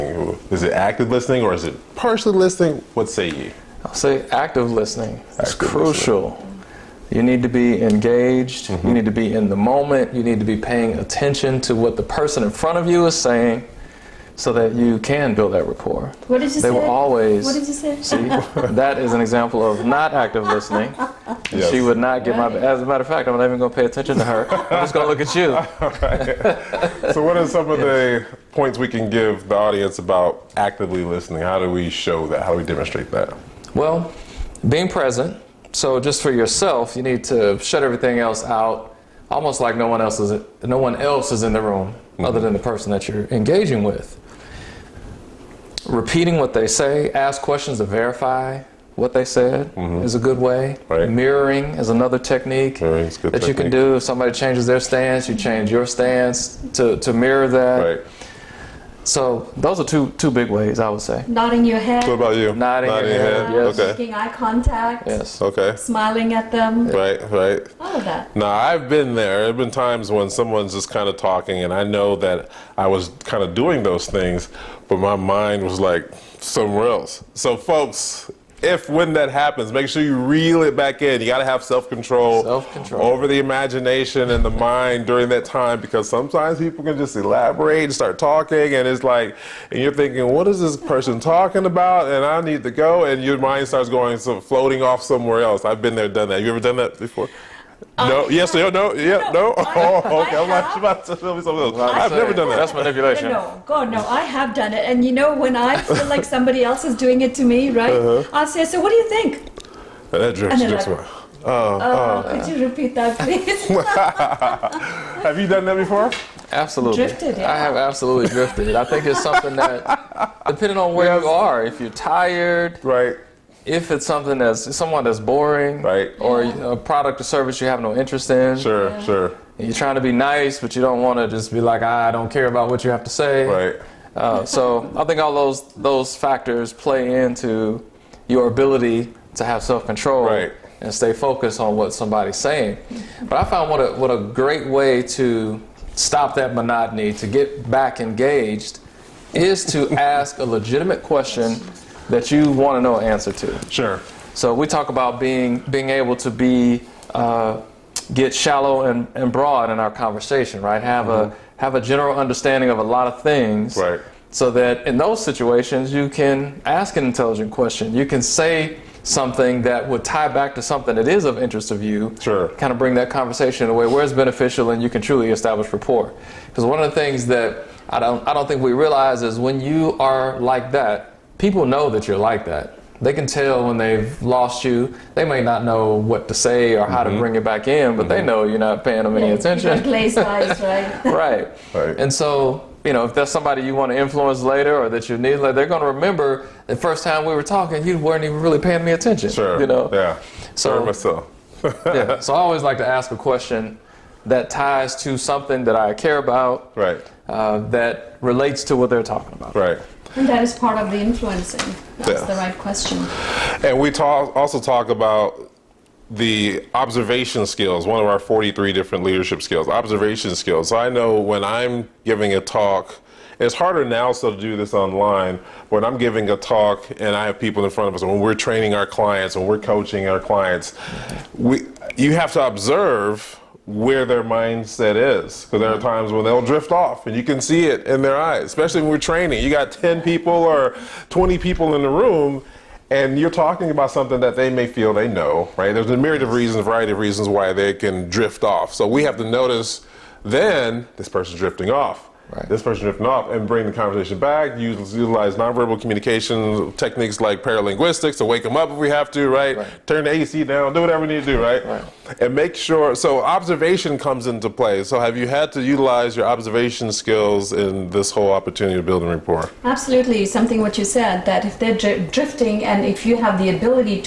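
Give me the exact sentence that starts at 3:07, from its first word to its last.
to bring it back in, but mm-hmm.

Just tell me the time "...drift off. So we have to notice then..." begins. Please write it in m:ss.
4:08.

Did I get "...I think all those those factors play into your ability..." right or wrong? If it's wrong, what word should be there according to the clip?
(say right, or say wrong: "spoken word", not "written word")
right.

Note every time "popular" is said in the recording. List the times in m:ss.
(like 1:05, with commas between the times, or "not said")
not said.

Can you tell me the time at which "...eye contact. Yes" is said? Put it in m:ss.
1:04.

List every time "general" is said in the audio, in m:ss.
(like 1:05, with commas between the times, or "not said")
2:41.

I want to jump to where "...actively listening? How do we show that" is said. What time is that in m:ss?
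0:30.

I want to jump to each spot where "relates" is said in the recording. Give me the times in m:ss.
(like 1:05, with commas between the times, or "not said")
3:28.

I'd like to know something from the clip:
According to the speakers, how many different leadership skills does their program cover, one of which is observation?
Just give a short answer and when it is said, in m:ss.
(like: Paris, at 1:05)
43, at 3:38.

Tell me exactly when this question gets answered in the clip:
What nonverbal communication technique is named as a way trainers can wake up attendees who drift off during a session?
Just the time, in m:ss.
4:17.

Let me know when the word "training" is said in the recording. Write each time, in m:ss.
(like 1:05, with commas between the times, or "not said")
3:48, 3:58.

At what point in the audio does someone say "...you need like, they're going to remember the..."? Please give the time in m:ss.
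3:15.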